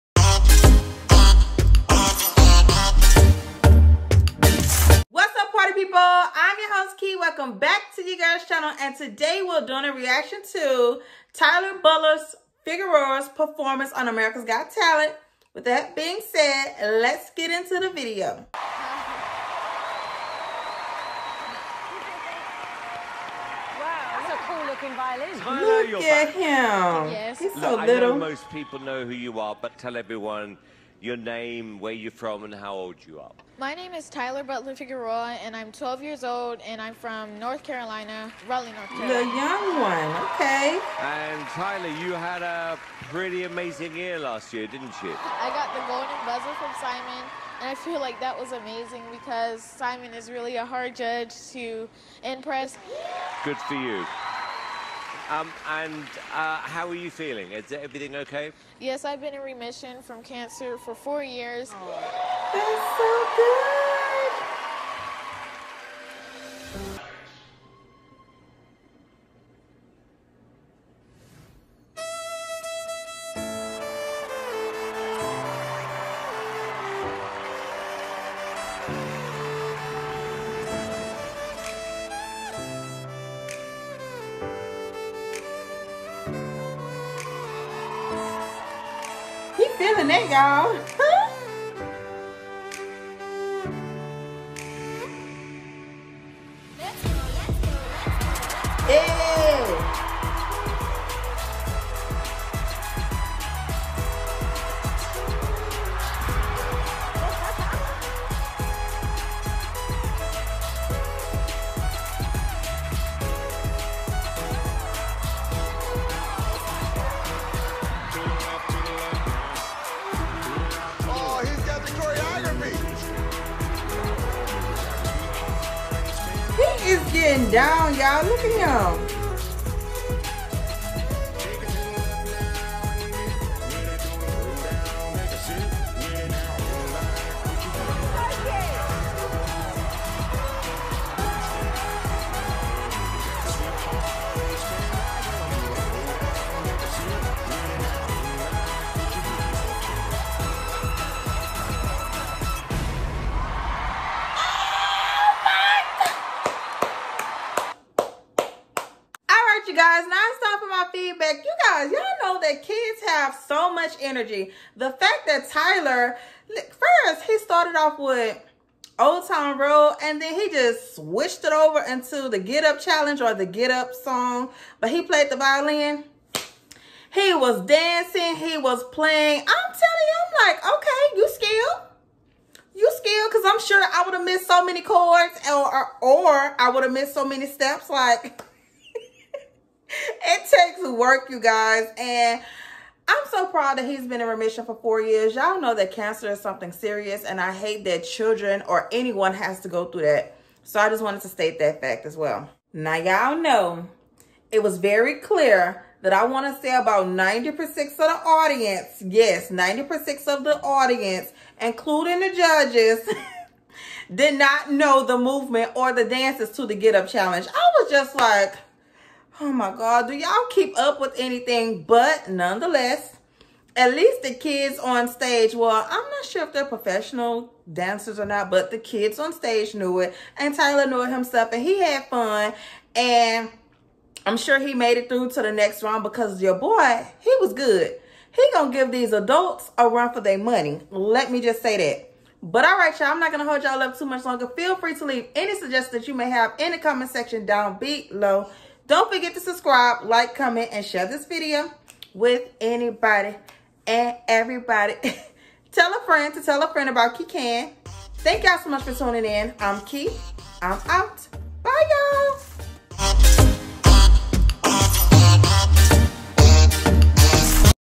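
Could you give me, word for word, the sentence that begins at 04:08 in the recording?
Don't forget to subscribe, like, comment, and share this video with anybody and everybody.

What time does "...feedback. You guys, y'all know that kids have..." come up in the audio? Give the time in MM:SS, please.
02:40.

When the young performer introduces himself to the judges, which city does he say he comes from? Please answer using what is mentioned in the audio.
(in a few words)
Raleigh.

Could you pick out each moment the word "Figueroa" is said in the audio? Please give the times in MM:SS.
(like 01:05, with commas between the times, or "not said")
00:12, 00:34.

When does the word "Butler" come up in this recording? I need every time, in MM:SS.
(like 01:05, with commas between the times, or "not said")
00:11, 00:34.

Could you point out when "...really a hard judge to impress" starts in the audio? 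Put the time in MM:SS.
00:50.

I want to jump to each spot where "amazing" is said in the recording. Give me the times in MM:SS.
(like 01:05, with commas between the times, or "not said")
00:43, 00:48.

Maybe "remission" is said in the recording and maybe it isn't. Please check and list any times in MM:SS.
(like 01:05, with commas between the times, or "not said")
00:59, 03:14.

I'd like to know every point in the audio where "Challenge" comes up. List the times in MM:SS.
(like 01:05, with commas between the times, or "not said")
02:52, 03:37.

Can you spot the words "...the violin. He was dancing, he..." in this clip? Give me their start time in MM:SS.
02:55.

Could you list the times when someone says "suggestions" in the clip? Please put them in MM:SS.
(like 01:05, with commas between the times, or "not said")
04:05.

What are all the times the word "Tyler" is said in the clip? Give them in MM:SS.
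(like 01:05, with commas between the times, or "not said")
00:11, 00:34, 00:41, 02:45, 03:50.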